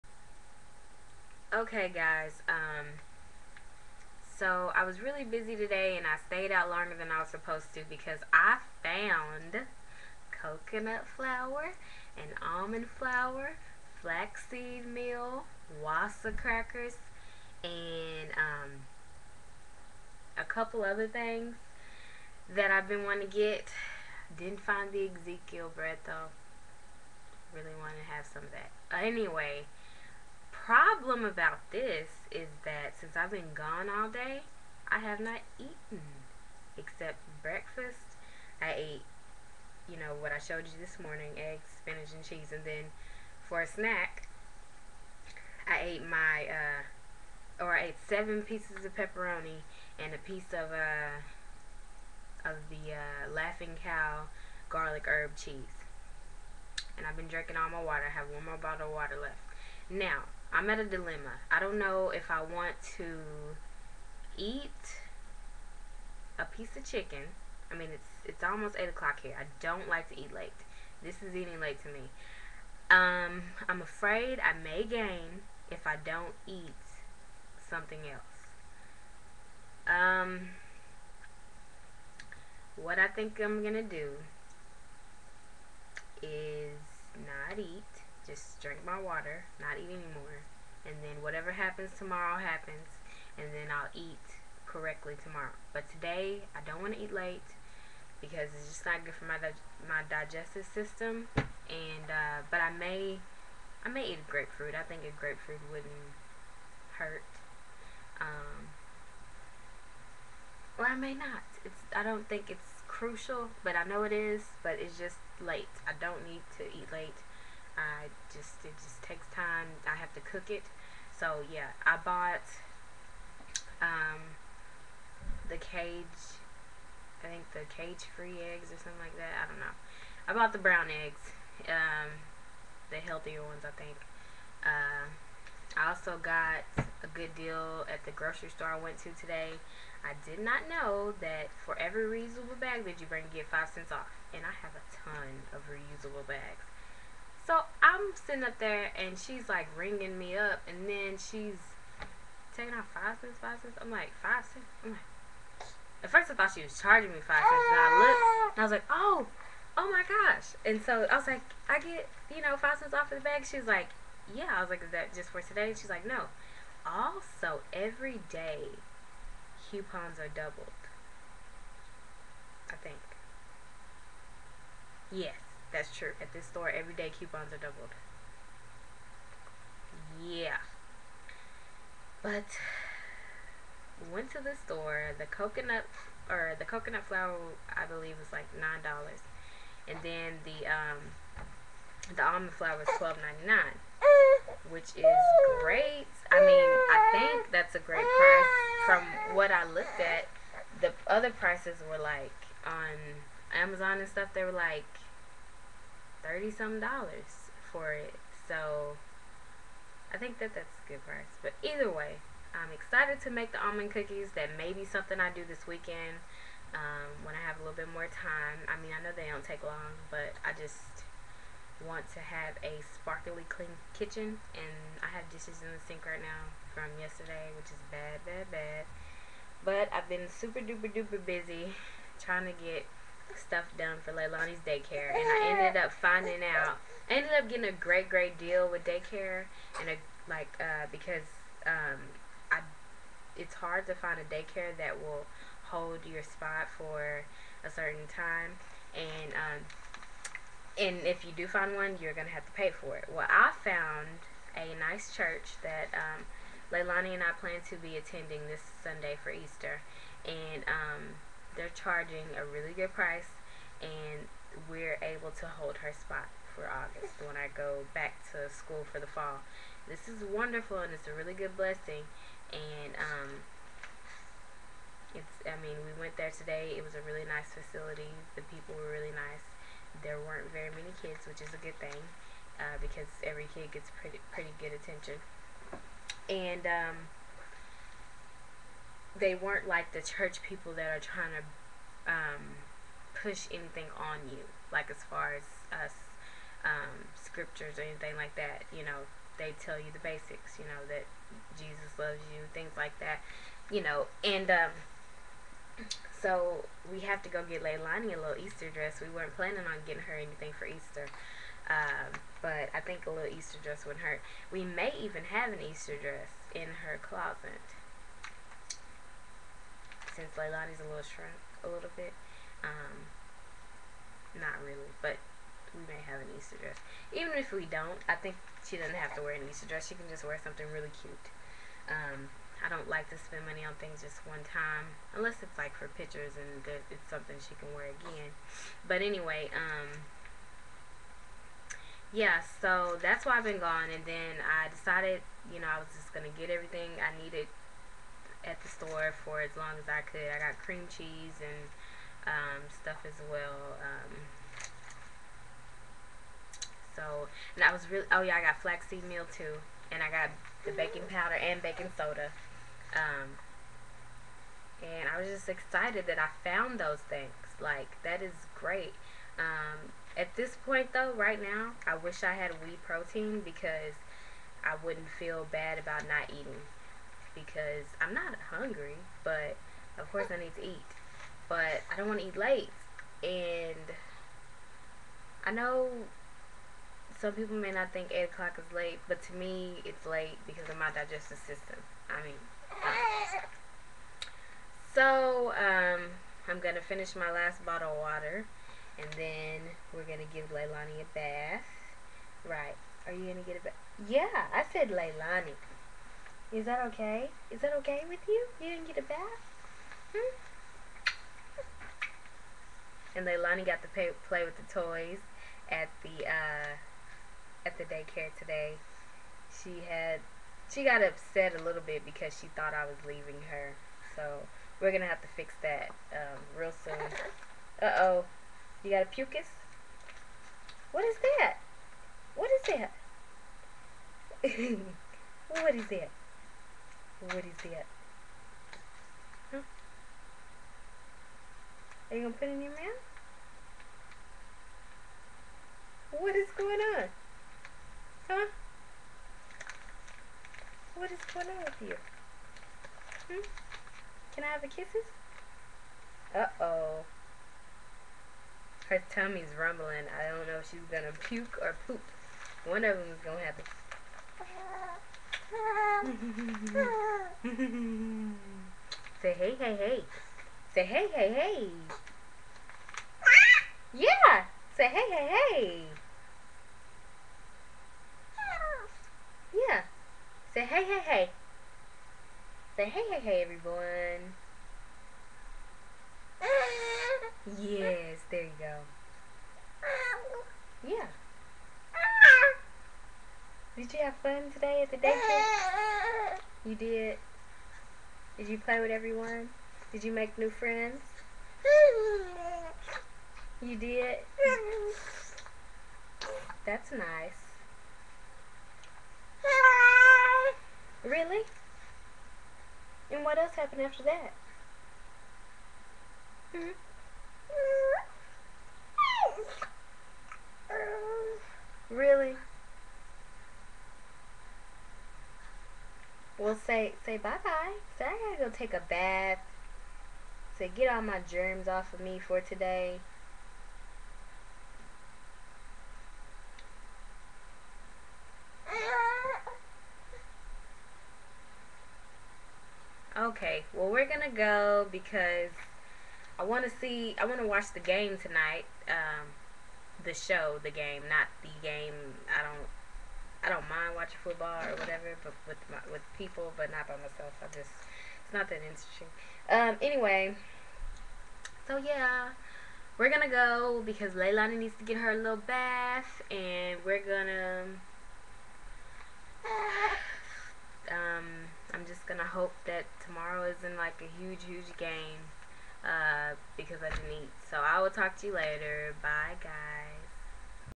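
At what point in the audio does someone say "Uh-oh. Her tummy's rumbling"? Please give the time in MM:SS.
07:36.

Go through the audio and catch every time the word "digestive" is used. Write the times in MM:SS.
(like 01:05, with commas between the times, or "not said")
01:40, 06:30.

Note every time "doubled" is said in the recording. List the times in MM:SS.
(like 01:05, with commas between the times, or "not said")
02:50, 02:57.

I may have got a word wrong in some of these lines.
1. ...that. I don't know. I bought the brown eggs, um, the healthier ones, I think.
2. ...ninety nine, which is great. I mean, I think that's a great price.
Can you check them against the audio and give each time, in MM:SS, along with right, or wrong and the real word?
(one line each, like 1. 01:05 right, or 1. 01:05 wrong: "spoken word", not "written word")
1. 02:09 right
2. 03:13 right.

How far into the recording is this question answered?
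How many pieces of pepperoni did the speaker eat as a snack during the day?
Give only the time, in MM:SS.
00:48.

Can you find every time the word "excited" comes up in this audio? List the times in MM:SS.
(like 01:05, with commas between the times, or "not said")
03:32, 06:05.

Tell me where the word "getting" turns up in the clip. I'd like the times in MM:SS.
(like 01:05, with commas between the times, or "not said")
03:57, 05:09.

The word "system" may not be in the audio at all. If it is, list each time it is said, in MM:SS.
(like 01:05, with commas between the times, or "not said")
01:40, 06:31.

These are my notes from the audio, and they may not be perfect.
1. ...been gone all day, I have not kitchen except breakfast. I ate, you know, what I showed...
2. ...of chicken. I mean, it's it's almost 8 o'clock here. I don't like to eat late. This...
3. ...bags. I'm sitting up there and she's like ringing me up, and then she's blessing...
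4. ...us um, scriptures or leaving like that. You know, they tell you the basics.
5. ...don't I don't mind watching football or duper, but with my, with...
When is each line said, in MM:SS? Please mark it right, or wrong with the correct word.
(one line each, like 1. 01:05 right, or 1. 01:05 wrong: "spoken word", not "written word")
1. 00:33 wrong: "eaten", not "kitchen"
2. 01:06 right
3. 02:26 wrong: "taking", not "blessing"
4. 04:55 wrong: "anything", not "leaving"
5. 09:12 wrong: "whatever", not "duper".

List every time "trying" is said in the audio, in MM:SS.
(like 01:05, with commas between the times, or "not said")
03:52, 04:50.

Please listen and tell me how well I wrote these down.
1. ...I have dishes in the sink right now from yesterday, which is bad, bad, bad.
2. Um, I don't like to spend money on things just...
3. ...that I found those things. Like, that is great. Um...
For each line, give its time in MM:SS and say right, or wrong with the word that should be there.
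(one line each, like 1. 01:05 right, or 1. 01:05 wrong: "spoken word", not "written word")
1. 03:45 right
2. 05:31 right
3. 06:06 right.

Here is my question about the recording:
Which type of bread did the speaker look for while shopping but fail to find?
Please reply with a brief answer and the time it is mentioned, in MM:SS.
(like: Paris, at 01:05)
Ezekiel bread, at 00:25.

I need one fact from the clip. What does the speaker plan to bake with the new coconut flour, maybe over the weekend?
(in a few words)
Almond cookies.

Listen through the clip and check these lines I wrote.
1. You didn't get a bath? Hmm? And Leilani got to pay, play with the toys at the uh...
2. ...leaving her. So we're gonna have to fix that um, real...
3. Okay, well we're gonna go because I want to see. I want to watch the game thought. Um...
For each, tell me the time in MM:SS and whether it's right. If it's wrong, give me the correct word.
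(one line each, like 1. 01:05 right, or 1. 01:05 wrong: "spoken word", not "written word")
1. 06:48 right
2. 07:03 right
3. 09:03 wrong: "tonight", not "thought".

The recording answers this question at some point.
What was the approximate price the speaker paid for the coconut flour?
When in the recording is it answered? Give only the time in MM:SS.
03:08.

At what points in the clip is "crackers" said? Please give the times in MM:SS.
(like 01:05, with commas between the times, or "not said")
00:16.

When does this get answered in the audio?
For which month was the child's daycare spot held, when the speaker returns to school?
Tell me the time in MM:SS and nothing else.
04:26.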